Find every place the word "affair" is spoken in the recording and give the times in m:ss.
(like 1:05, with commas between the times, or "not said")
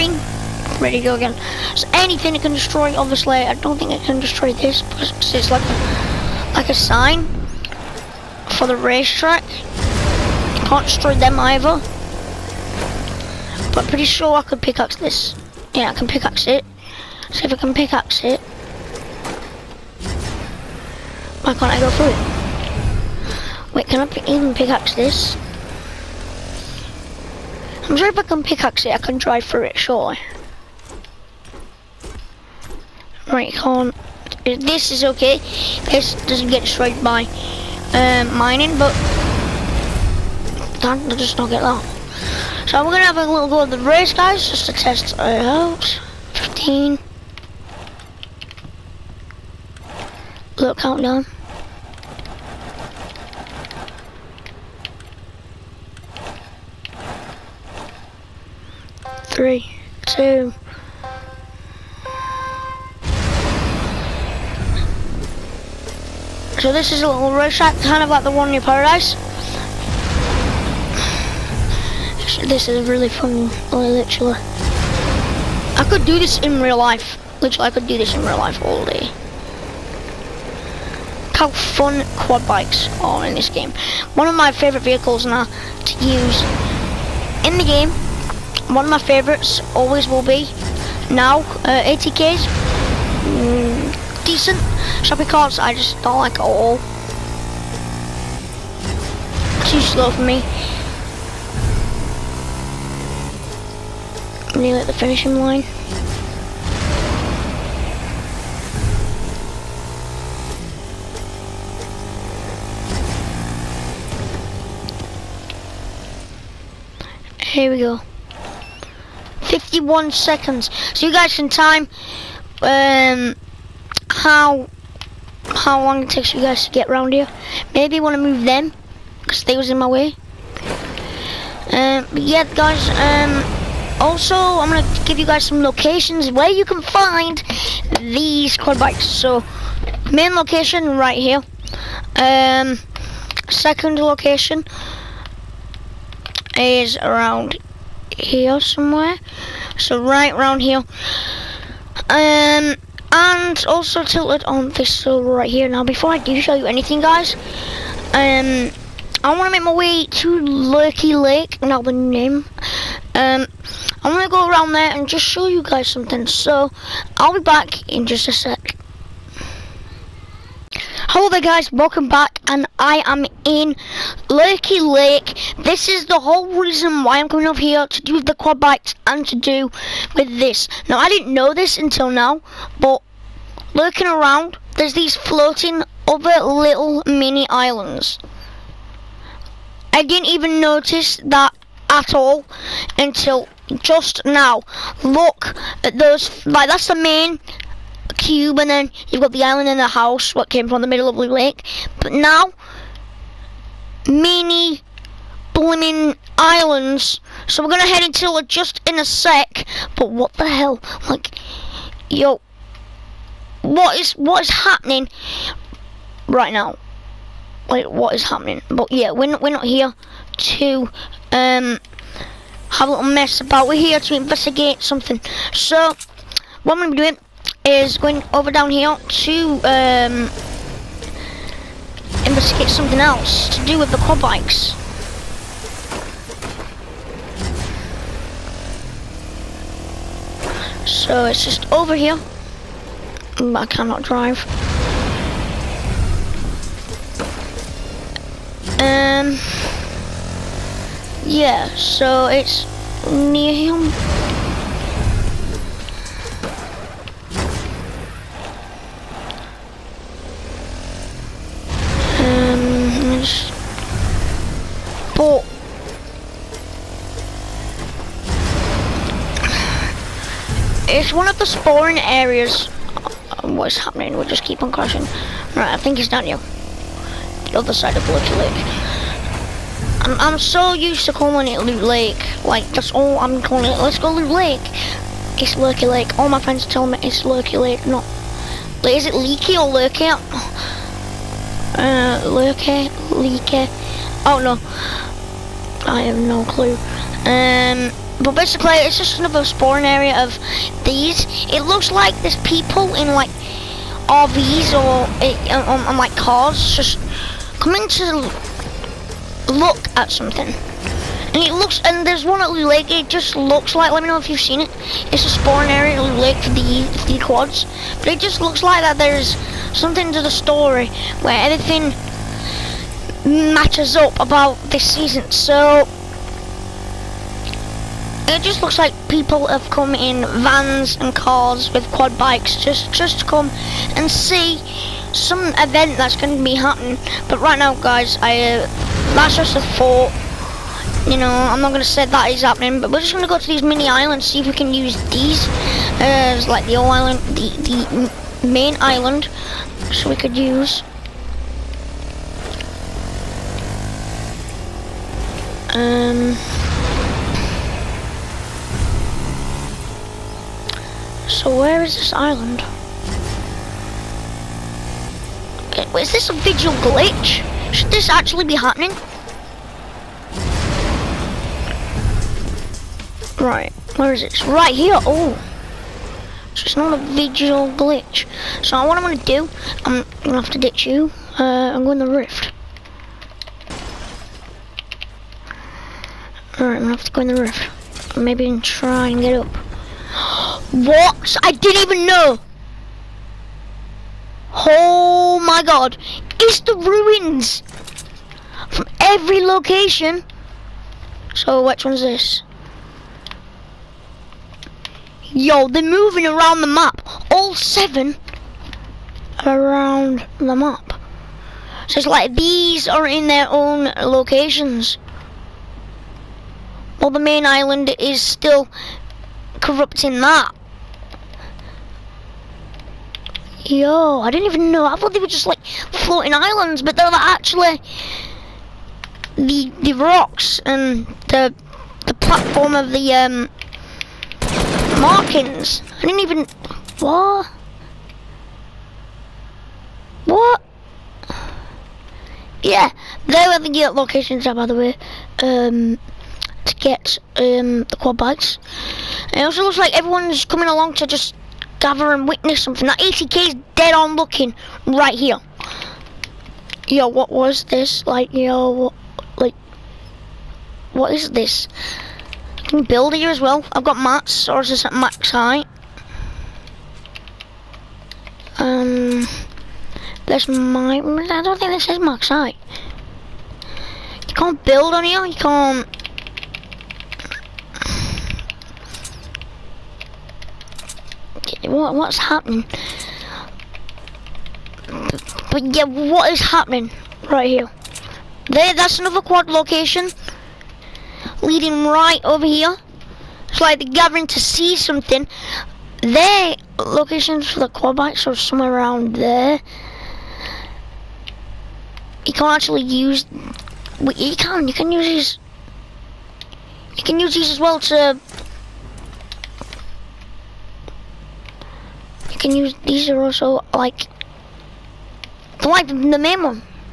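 not said.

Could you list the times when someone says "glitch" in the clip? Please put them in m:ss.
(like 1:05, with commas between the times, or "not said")
6:06, 6:17.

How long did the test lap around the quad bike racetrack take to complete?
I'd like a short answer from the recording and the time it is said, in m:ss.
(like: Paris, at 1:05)
51 seconds, at 1:59.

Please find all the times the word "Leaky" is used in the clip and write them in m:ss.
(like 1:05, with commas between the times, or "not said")
4:49, 4:53.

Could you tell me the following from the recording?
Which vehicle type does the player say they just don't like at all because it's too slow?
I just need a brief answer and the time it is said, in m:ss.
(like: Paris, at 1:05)
Shopping carts, at 1:35.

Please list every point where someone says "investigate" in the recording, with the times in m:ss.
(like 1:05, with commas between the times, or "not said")
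3:44, 3:52.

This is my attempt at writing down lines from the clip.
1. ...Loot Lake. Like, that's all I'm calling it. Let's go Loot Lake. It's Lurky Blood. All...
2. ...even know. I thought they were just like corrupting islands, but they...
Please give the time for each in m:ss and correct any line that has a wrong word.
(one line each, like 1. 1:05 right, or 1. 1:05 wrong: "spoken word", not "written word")
1. 4:41 wrong: "Lake", not "Blood"
2. 7:04 wrong: "floating", not "corrupting".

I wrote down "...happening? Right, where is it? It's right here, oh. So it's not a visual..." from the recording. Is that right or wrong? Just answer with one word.
right.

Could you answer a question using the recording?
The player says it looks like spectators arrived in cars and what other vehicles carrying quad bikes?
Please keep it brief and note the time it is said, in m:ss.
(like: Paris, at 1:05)
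RVs, at 5:04.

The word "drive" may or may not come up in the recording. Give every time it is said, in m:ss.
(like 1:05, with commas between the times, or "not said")
0:29, 4:04.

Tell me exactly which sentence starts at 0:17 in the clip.
See if I can pickaxe it, why can't I go through it?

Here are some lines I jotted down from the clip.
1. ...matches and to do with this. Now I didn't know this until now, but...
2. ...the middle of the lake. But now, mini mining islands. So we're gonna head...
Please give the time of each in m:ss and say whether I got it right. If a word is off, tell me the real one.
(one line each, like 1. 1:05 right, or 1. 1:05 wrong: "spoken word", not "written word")
1. 2:58 wrong: "bikes", not "matches"
2. 3:20 wrong: "blooming", not "mining".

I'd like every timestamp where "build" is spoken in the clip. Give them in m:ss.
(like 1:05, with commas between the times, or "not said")
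7:42, 7:54.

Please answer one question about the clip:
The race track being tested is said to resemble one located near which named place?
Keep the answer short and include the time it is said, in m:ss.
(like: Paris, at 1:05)
Paradise, at 1:08.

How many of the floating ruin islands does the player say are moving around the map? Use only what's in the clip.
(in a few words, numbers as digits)
7.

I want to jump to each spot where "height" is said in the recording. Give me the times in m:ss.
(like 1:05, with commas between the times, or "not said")
7:45, 7:52.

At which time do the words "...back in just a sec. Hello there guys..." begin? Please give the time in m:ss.
2:47.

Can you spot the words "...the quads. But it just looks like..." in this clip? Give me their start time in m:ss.
5:17.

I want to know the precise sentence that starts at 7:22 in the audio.
Yeah, they were the uh, locations uh, by the way, um, to get um, the quad bikes.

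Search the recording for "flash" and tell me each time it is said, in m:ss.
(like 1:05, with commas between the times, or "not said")
not said.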